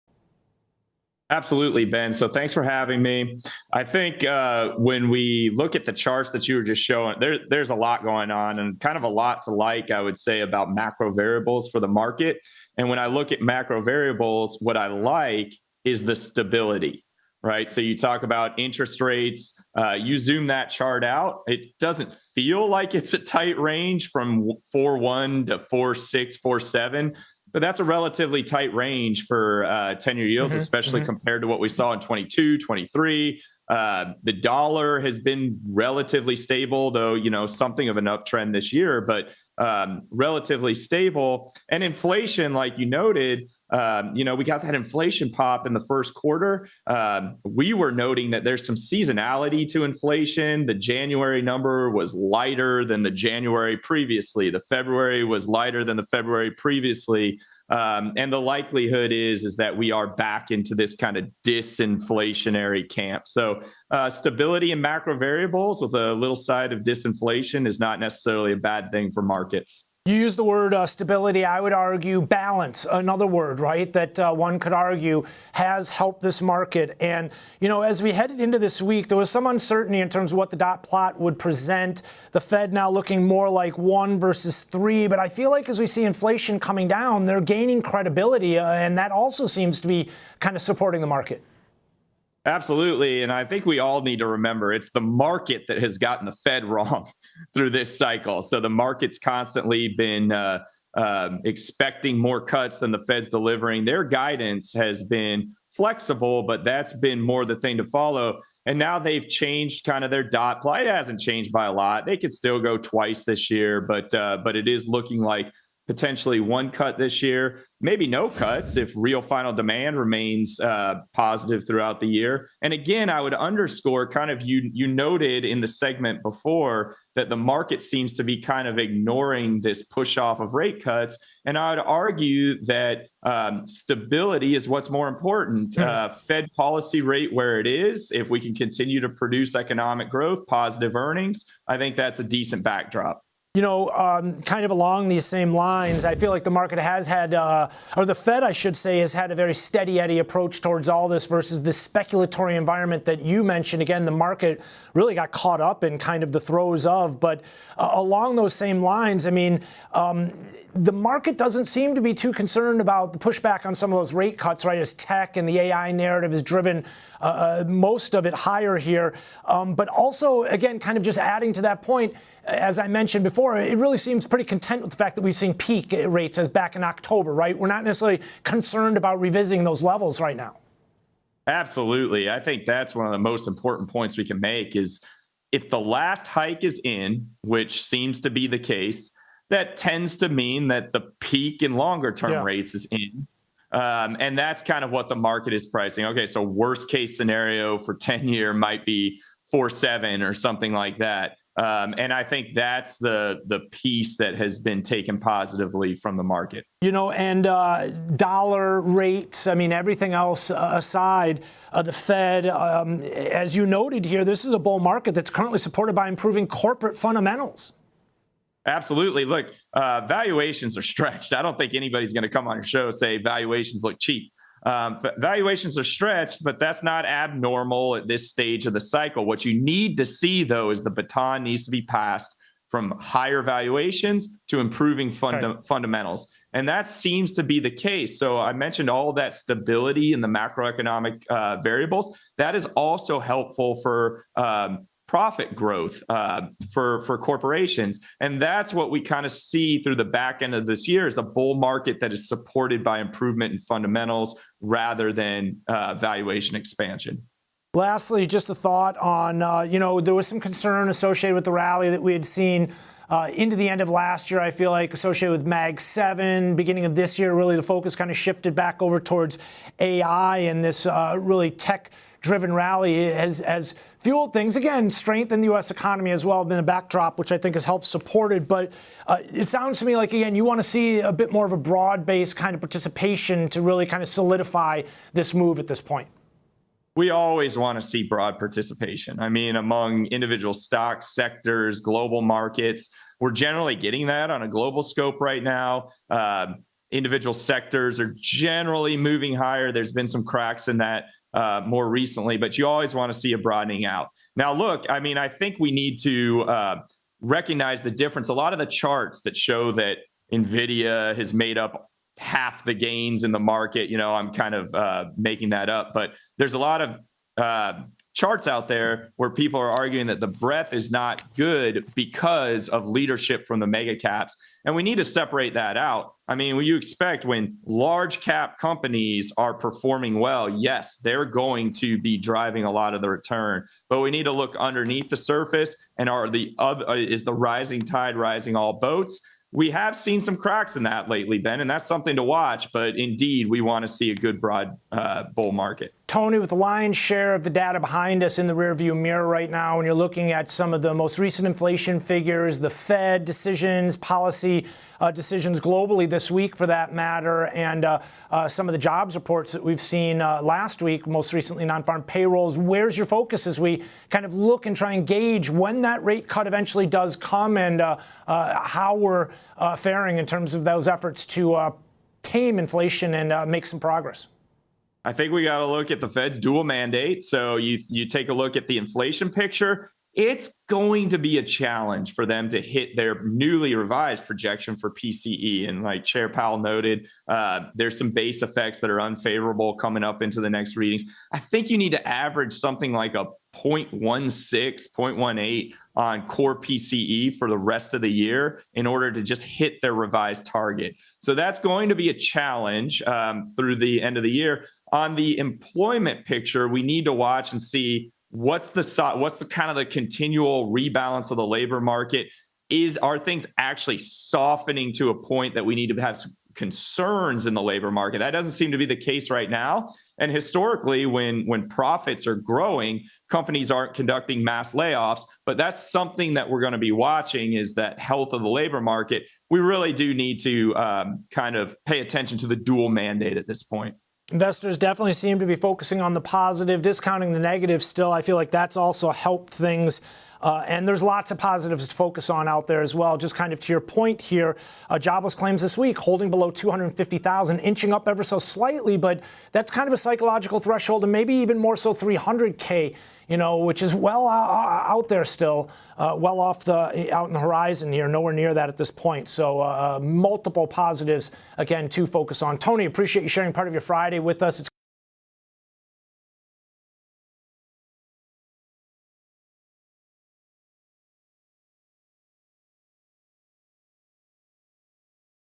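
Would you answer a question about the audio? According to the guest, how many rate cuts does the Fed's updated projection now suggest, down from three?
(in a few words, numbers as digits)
1.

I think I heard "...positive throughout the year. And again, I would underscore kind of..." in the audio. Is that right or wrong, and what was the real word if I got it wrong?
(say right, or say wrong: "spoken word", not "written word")
right.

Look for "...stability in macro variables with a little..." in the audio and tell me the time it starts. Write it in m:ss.
1:04.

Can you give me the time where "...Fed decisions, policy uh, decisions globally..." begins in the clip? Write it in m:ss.
5:52.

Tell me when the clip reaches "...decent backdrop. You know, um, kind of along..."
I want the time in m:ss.
2:22.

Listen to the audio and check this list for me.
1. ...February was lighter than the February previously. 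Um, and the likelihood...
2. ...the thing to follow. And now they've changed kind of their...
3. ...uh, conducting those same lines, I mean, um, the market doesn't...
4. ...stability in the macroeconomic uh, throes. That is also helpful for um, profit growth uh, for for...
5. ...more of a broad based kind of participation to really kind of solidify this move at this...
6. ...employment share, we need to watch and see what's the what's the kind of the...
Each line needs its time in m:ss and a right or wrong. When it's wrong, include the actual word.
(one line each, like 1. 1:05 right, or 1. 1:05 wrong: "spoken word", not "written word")
1. 0:54 right
2. 1:47 right
3. 2:37 wrong: "along", not "conducting"
4. 3:59 wrong: "variables", not "throes"
5. 4:41 right
6. 6:45 wrong: "picture", not "share".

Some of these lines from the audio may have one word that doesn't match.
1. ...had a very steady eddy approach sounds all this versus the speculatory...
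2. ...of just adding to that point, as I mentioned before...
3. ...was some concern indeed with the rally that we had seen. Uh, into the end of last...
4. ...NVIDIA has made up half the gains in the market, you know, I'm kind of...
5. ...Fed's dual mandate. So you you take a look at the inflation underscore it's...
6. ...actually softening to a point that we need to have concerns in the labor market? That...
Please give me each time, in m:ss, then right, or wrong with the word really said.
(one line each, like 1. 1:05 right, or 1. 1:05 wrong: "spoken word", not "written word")
1. 2:29 wrong: "towards", not "sounds"
2. 2:50 right
3. 4:20 wrong: "associated", not "indeed"
4. 5:10 right
5. 6:16 wrong: "picture", not "underscore"
6. 6:53 right.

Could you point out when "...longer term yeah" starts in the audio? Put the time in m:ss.
3:11.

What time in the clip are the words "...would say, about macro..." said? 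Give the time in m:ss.
0:10.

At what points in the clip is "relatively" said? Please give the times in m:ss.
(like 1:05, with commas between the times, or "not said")
0:27, 0:35, 0:40.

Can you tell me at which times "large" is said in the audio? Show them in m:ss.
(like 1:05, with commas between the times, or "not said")
5:27.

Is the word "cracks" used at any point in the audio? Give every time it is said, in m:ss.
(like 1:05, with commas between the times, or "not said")
5:00, 5:40.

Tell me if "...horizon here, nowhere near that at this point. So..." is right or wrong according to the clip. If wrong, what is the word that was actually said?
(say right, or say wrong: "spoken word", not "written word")
right.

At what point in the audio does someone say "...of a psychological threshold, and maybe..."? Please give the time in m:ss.
7:29.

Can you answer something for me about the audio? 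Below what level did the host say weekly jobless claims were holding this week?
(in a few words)
250,000.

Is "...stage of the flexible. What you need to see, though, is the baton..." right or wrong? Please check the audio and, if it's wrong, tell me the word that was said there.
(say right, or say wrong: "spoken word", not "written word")
wrong: "cycle", not "flexible".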